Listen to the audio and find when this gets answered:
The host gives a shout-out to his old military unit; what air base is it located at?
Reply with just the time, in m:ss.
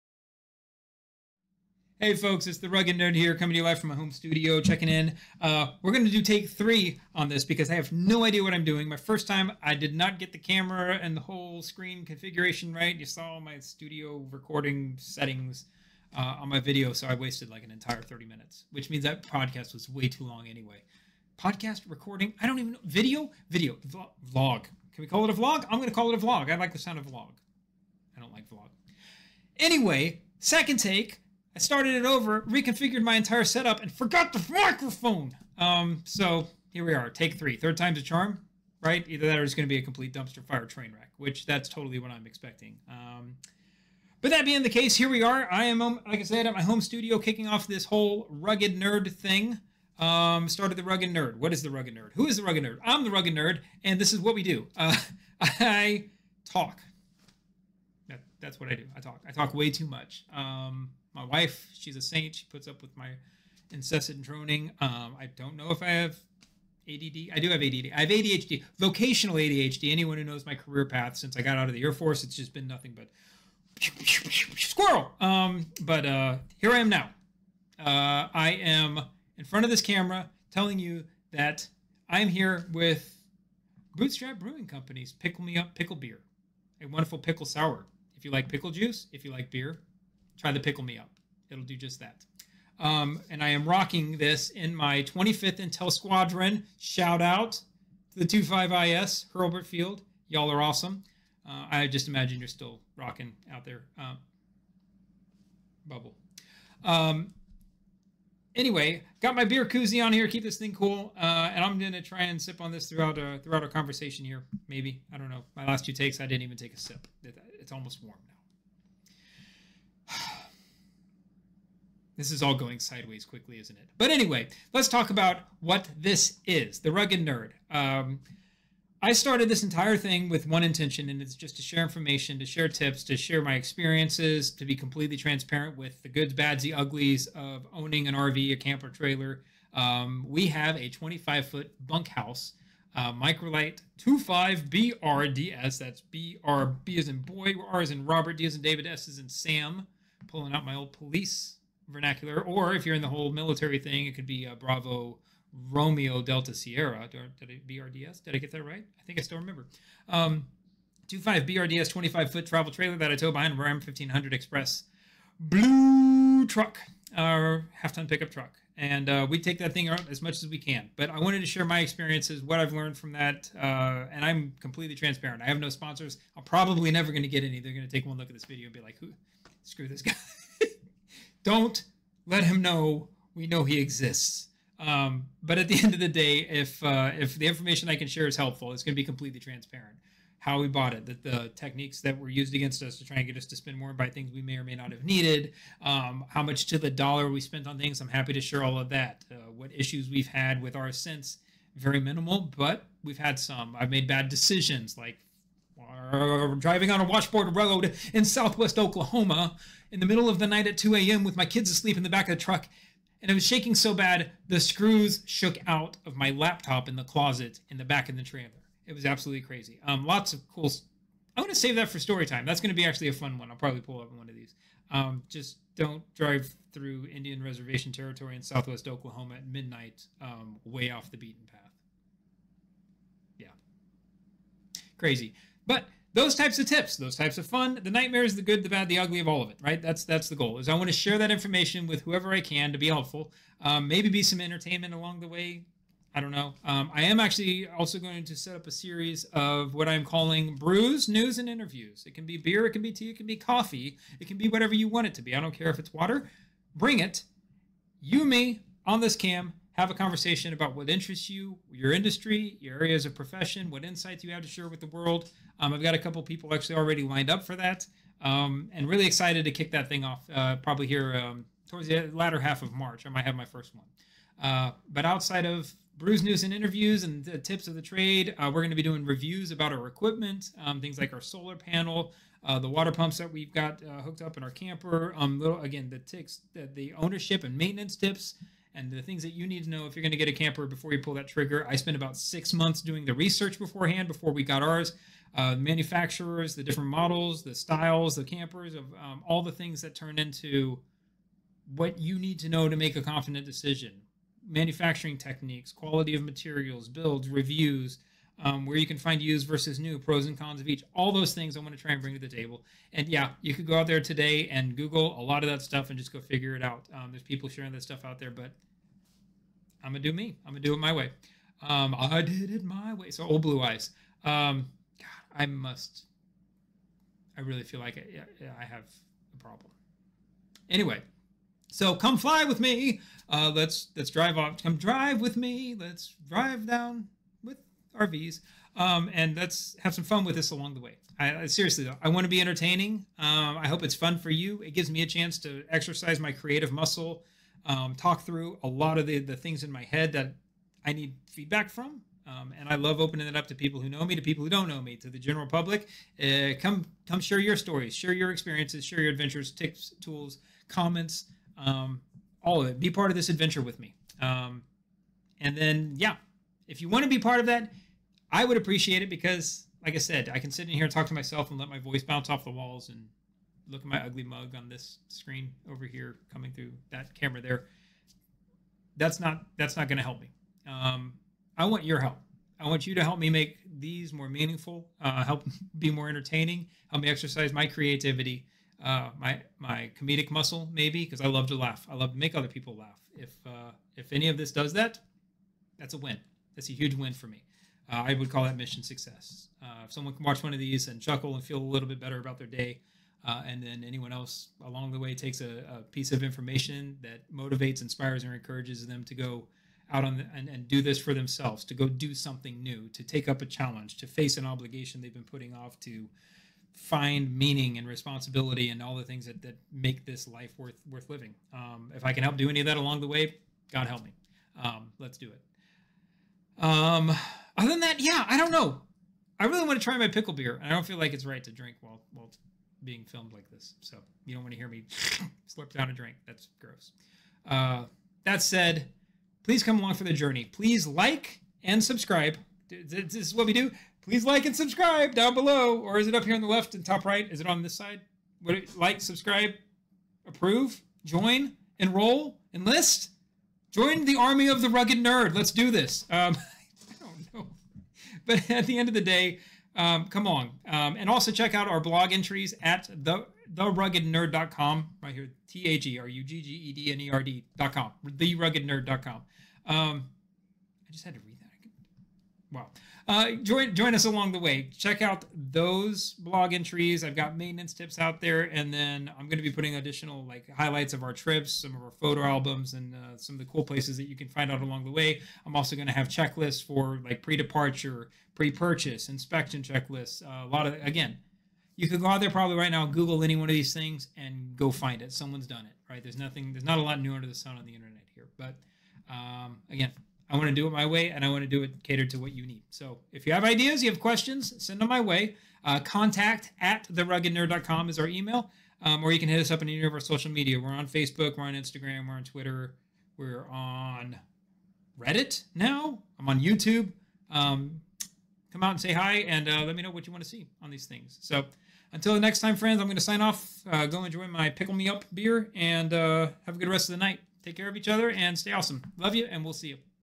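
1:39.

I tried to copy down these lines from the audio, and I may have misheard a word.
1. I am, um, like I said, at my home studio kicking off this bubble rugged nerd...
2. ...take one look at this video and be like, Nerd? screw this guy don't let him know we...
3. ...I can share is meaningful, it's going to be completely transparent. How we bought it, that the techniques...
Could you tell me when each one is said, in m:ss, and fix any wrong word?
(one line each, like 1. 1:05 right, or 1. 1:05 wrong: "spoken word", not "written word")
1. 0:45 wrong: "whole", not "bubble"
2. 2:57 wrong: "Who", not "Nerd"
3. 3:07 wrong: "helpful", not "meaningful".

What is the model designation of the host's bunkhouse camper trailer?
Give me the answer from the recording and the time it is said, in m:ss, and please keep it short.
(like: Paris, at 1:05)
Microlite 25BRDS, at 2:23.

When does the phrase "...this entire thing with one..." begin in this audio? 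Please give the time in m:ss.
2:09.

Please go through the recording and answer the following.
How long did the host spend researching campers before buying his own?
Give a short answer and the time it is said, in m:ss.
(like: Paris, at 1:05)
about six months, at 4:51.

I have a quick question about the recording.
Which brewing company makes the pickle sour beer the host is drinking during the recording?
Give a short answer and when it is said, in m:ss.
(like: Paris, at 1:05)
Bootstrap Brewing Company, at 1:23.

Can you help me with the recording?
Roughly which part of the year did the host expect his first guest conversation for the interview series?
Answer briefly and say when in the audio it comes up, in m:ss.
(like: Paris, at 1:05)
latter half of March, at 4:32.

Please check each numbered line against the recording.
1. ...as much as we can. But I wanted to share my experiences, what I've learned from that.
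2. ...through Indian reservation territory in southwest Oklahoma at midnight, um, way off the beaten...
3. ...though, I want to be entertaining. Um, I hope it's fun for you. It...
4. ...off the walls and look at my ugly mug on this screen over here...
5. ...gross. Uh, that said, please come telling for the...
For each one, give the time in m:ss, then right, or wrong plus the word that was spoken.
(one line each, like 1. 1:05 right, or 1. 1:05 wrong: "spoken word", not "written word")
1. 2:50 right
2. 3:46 right
3. 5:41 right
4. 6:12 right
5. 7:16 wrong: "along", not "telling".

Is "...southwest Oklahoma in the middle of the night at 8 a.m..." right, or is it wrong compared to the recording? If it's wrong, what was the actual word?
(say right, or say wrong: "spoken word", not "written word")
wrong: "2", not "8".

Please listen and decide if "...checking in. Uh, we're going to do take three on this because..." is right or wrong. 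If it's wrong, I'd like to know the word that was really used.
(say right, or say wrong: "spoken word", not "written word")
right.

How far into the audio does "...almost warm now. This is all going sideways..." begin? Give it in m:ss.
1:57.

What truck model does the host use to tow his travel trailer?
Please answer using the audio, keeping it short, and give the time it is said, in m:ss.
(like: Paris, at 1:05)
Ram 1500, at 2:43.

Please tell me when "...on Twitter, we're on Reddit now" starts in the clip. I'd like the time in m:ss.
8:32.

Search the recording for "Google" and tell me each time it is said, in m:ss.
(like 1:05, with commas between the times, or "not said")
5:14, 8:12.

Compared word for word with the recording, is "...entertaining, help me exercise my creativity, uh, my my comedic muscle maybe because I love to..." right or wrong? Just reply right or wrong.
right.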